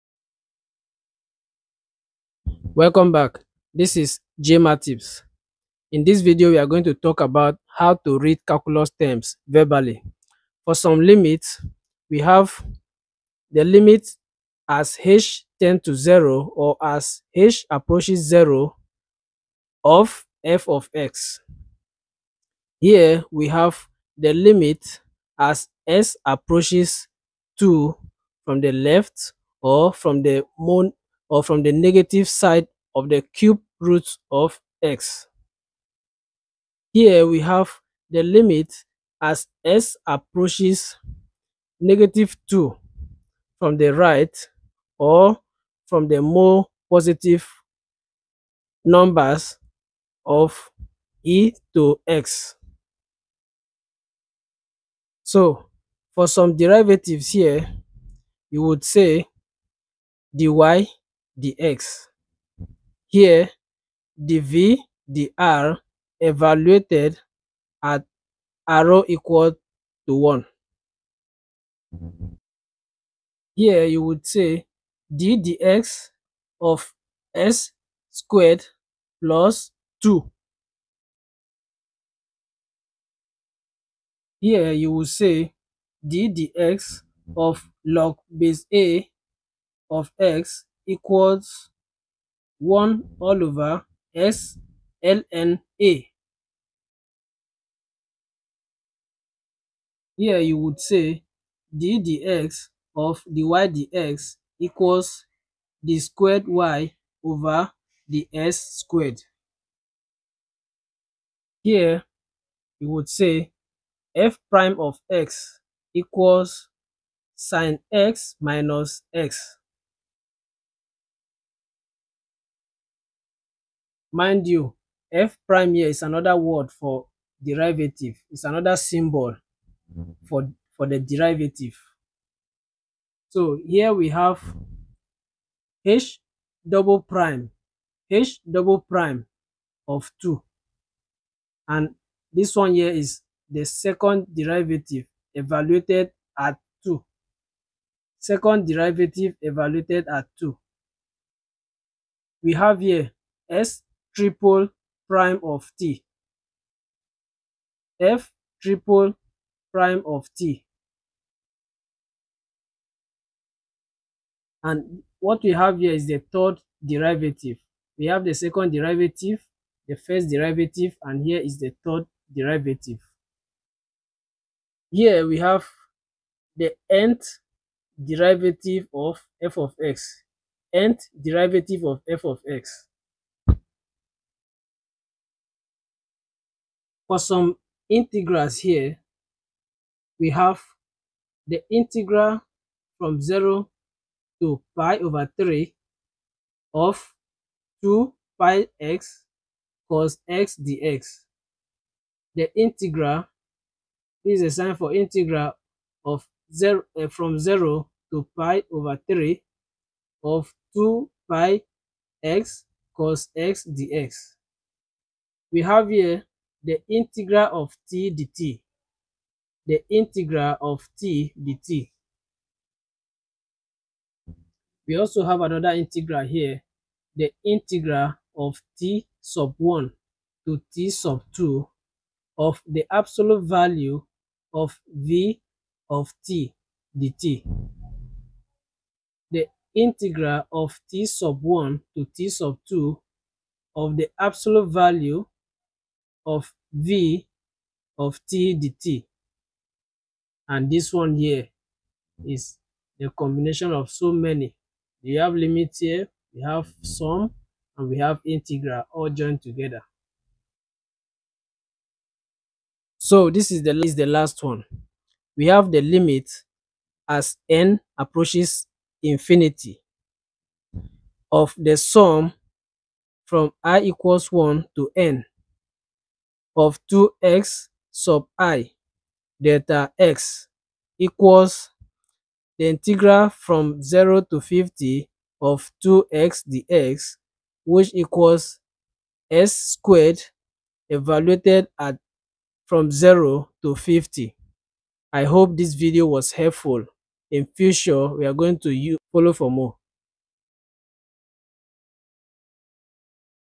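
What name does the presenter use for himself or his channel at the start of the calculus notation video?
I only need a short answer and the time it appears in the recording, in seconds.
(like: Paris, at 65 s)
Jay Mathtips, at 4 s.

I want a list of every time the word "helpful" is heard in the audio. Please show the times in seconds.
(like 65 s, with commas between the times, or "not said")
296 s.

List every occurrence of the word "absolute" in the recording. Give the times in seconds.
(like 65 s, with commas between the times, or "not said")
232 s, 244 s.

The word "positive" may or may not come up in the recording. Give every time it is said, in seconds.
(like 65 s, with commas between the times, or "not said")
46 s.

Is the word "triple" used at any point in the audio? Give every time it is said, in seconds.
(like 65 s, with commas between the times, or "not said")
154 s, 158 s.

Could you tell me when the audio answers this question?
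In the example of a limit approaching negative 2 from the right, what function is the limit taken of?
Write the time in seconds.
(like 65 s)
51 s.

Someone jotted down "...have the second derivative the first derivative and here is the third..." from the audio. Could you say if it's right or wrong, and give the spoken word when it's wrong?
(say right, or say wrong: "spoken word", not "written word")
right.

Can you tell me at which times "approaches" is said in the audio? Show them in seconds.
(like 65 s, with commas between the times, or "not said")
17 s, 26 s, 40 s, 267 s.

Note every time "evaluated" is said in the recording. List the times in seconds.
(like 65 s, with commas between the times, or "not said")
66 s, 145 s, 149 s, 290 s.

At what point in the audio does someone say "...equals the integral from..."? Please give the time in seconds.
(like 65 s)
280 s.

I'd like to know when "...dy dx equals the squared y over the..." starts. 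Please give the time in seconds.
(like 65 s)
103 s.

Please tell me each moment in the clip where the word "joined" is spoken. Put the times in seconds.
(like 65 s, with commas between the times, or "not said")
259 s.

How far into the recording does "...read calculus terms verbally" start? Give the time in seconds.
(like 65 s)
8 s.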